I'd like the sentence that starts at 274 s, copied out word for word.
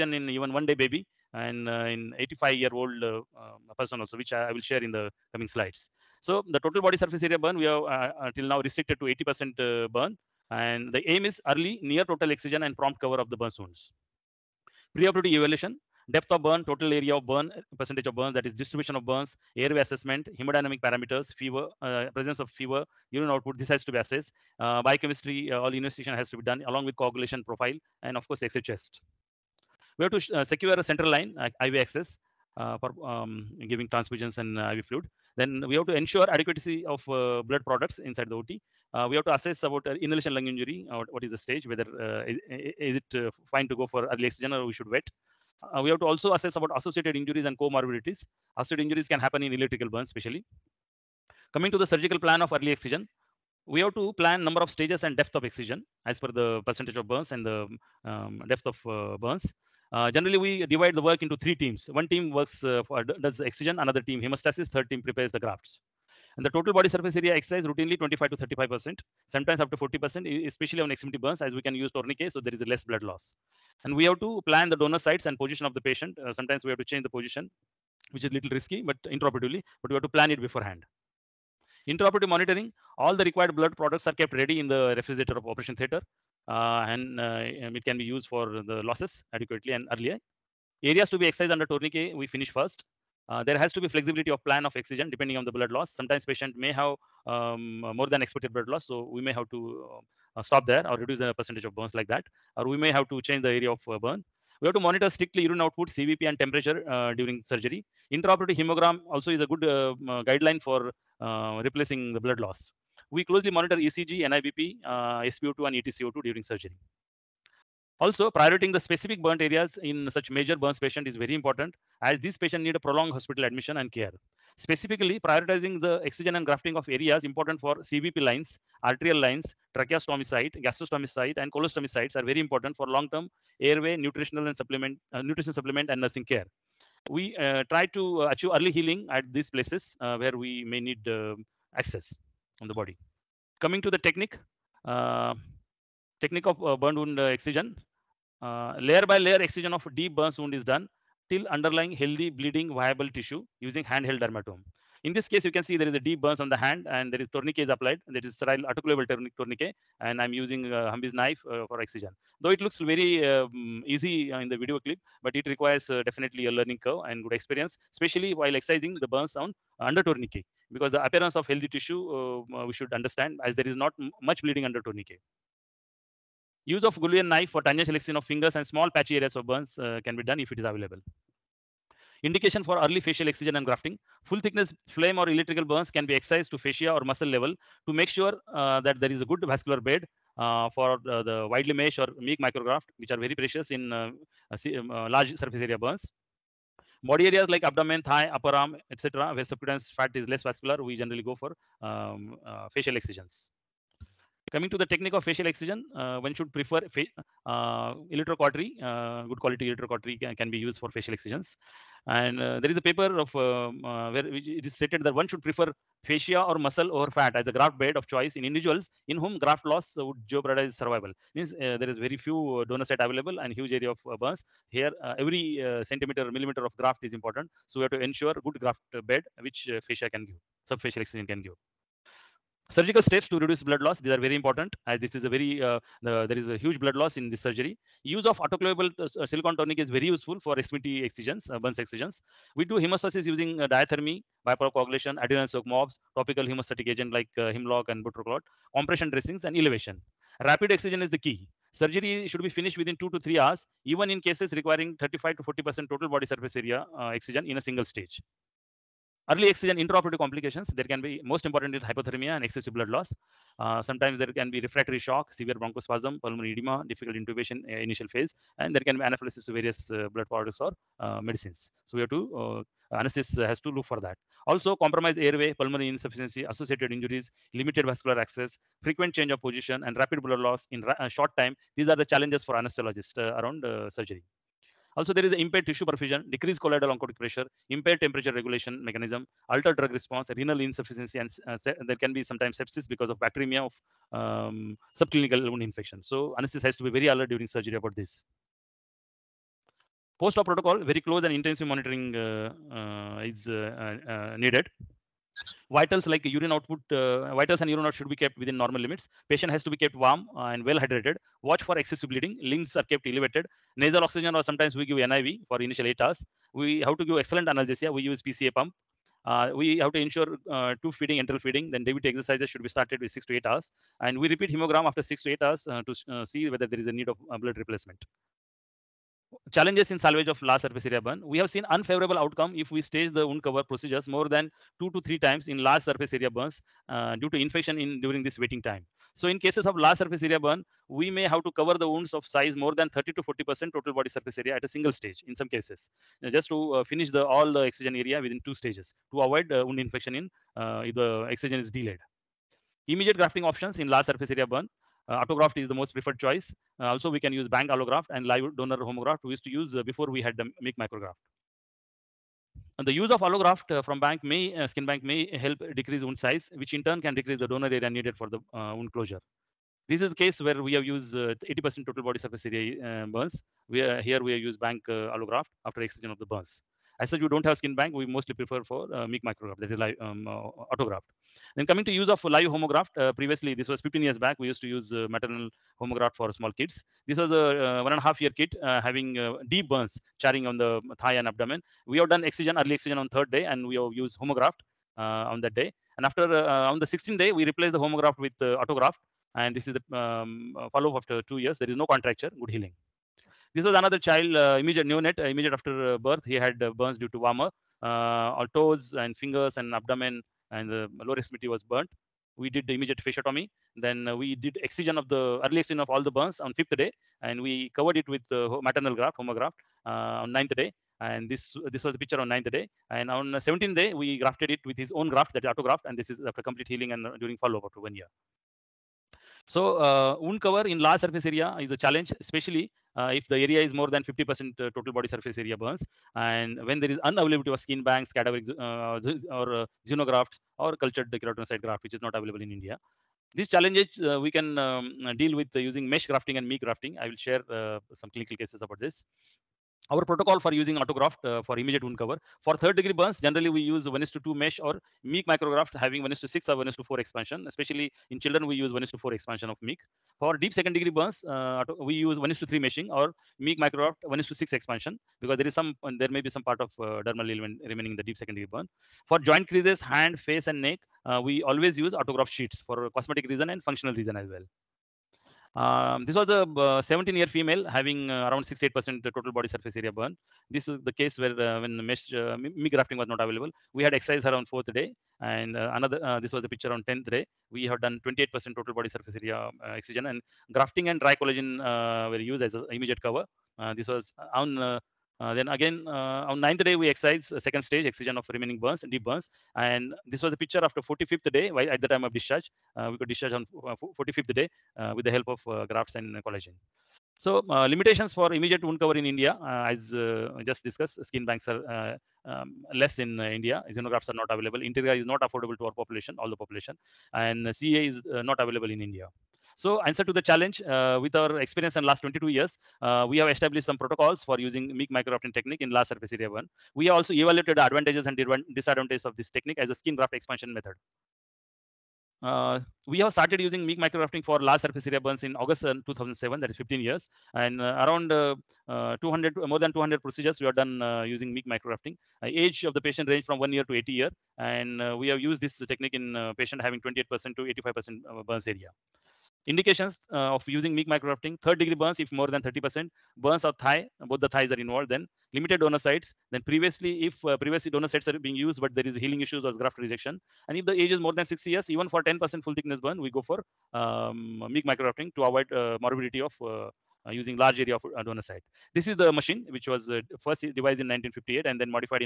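Also, compromised airway, pulmonary insufficiency, associated injuries, limited vascular access, frequent change of position, and rapid blood loss in a short time.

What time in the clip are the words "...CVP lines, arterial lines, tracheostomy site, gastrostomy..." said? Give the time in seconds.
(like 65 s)
127 s.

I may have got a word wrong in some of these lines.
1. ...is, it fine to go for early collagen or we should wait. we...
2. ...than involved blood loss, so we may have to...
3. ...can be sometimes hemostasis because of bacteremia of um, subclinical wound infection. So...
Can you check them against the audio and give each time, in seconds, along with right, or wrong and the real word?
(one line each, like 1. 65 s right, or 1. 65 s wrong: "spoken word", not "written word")
1. 42 s wrong: "oxygen", not "collagen"
2. 98 s wrong: "expected", not "involved"
3. 291 s wrong: "sepsis", not "hemostasis".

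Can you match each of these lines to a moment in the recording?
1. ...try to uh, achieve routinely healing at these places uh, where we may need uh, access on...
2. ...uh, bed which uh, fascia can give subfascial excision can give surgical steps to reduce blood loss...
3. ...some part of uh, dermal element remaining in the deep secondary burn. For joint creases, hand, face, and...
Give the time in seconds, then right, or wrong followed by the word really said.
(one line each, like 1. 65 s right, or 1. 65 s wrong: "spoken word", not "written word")
1. 137 s wrong: "early", not "routinely"
2. 228 s right
3. 466 s right.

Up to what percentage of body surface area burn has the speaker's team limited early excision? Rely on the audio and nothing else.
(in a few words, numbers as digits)
80%.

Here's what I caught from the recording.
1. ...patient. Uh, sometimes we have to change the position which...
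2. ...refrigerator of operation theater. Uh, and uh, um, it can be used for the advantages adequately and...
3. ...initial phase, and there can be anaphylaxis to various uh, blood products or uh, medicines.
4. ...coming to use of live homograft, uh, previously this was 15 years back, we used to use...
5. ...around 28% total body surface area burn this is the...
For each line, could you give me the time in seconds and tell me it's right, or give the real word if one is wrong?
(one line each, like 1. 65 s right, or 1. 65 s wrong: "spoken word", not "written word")
1. 75 s right
2. 84 s wrong: "losses", not "advantages"
3. 267 s right
4. 381 s right
5. 478 s wrong: "68", not "28".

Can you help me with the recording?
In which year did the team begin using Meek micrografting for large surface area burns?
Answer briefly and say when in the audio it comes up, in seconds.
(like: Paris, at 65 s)
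2007, at 535 s.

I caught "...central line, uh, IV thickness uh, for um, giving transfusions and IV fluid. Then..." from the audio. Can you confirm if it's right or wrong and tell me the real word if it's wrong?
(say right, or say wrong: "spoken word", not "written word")
wrong: "access", not "thickness".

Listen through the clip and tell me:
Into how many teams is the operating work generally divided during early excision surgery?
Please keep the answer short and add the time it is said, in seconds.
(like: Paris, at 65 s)
3, at 61 s.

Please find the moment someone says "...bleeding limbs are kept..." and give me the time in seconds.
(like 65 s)
312 s.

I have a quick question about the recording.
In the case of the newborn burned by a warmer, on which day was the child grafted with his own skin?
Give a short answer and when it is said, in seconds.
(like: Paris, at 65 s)
17th day, at 423 s.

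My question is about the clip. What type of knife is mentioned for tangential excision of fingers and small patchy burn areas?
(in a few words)
Goulian knife.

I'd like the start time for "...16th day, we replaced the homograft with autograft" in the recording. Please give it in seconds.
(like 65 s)
396 s.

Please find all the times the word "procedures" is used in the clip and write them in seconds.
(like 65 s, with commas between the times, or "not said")
333 s, 540 s.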